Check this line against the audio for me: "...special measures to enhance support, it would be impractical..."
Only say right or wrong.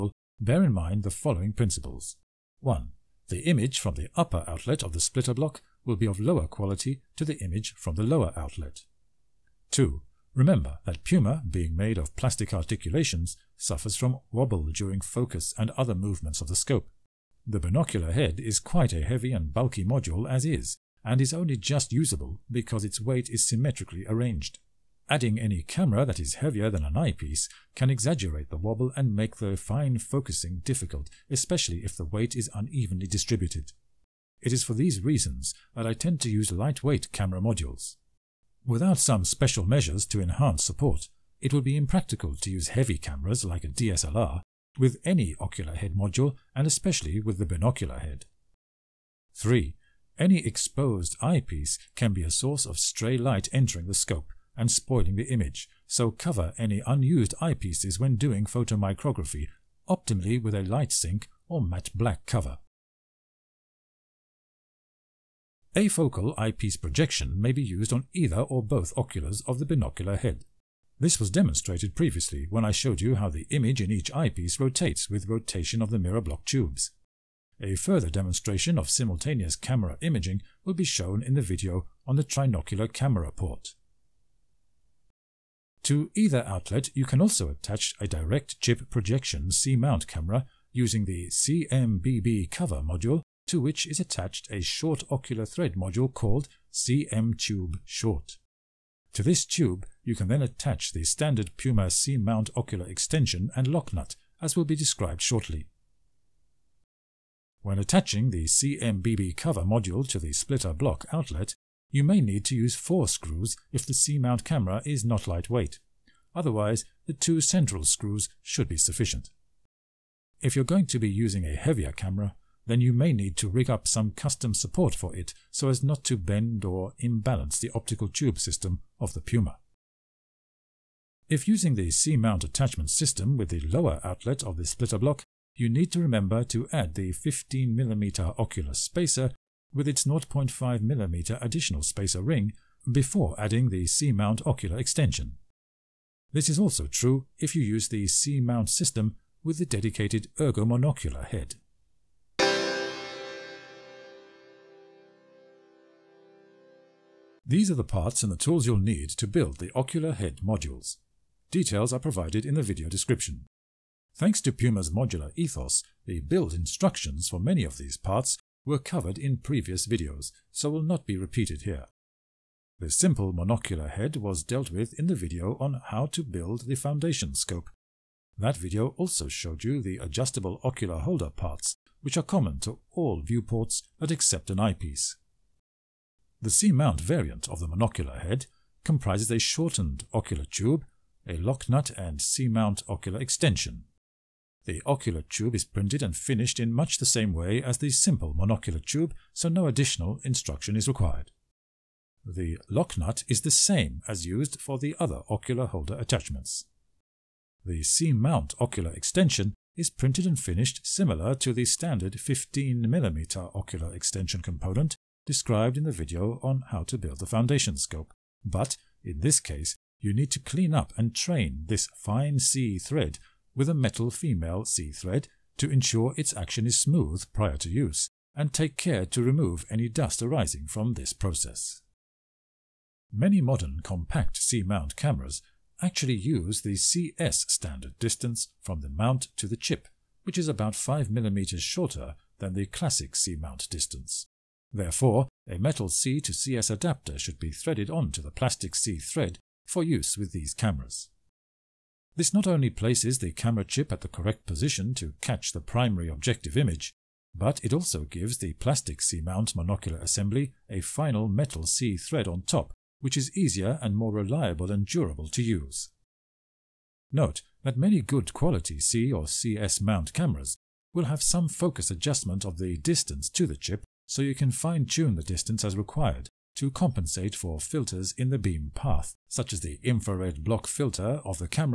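right.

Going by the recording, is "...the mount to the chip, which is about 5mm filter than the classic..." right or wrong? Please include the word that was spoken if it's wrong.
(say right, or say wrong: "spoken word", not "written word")
wrong: "shorter", not "filter".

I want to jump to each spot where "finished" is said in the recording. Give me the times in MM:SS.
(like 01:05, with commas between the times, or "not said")
03:16, 03:30.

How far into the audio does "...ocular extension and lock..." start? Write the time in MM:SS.
01:42.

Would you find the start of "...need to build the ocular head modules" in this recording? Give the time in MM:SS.
02:38.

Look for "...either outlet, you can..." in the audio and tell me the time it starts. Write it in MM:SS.
01:26.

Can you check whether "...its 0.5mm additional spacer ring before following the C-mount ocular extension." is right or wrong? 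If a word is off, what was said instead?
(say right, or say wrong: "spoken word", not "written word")
wrong: "adding", not "following".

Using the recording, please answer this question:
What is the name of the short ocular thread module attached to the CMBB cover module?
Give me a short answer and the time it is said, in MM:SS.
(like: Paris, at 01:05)
CM Tube Short, at 01:36.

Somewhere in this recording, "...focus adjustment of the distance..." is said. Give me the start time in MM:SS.
04:31.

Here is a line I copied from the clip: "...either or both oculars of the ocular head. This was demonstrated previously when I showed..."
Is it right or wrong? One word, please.
wrong.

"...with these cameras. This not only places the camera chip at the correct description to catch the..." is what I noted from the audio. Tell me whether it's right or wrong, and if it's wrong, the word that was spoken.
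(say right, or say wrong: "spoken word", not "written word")
wrong: "position", not "description".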